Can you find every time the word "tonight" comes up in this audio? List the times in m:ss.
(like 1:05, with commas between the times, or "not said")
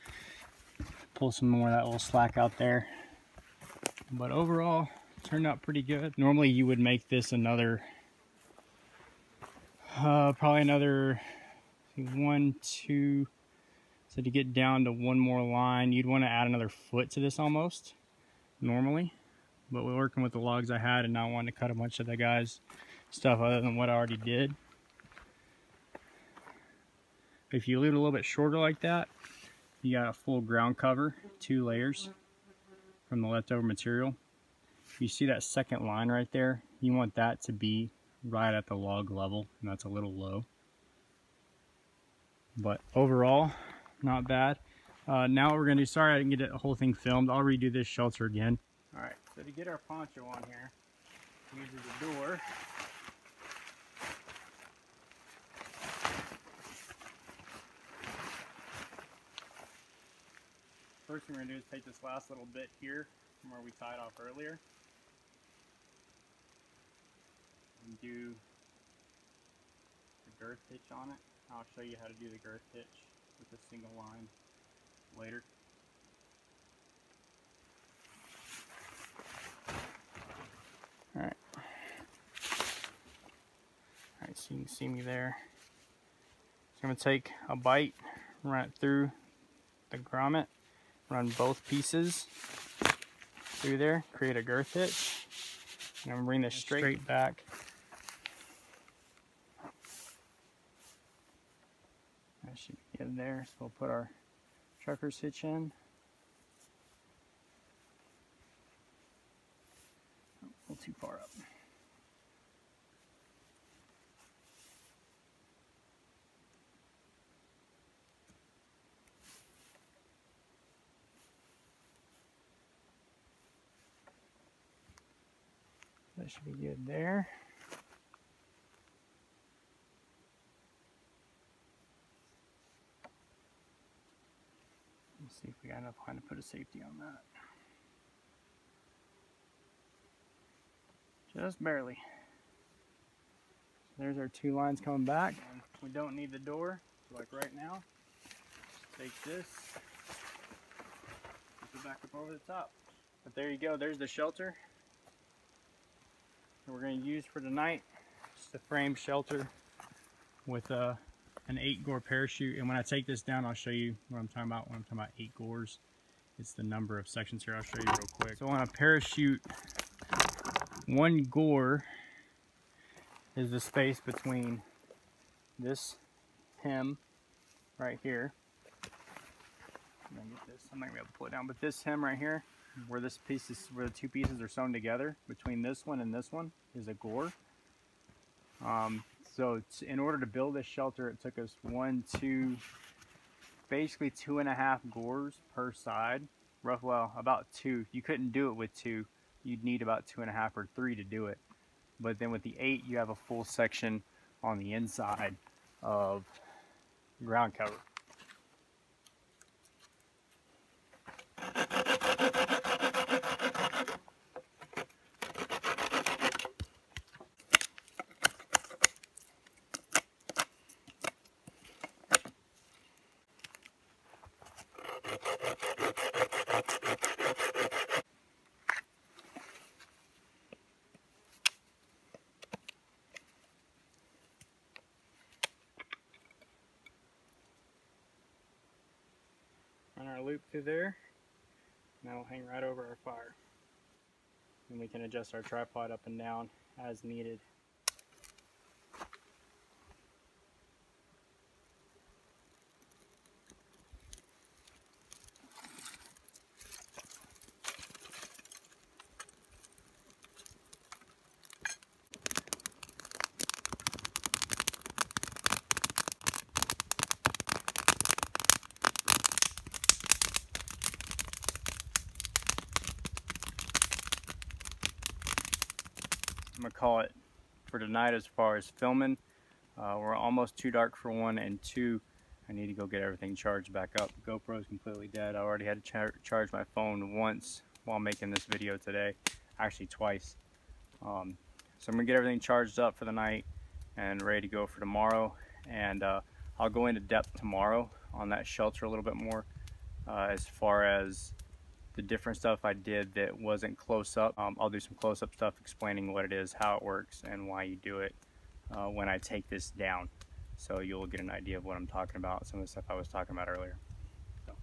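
2:37, 4:37.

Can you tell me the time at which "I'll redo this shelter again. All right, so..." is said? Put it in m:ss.
0:47.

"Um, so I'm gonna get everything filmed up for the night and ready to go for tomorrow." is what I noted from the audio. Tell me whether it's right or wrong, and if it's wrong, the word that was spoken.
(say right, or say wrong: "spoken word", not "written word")
wrong: "charged", not "filmed".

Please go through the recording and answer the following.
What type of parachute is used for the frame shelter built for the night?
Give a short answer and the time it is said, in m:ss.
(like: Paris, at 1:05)
eight gore parachute, at 2:41.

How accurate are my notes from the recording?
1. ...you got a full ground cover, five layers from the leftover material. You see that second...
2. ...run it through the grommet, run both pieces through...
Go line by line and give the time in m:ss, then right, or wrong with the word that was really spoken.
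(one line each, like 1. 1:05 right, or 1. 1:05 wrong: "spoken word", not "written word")
1. 0:29 wrong: "two", not "five"
2. 1:28 right.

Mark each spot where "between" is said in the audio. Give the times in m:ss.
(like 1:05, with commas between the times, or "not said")
2:53, 3:05.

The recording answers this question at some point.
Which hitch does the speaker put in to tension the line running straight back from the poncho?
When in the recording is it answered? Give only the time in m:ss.
1:44.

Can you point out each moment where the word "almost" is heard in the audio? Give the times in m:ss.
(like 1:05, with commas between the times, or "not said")
0:17, 4:40.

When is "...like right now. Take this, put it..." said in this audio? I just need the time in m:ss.
2:27.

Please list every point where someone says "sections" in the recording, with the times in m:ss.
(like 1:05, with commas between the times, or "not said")
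2:47, 3:23.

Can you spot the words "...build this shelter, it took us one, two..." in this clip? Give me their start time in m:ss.
3:10.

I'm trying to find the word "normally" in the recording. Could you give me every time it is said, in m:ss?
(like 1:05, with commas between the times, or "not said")
0:06, 0:18.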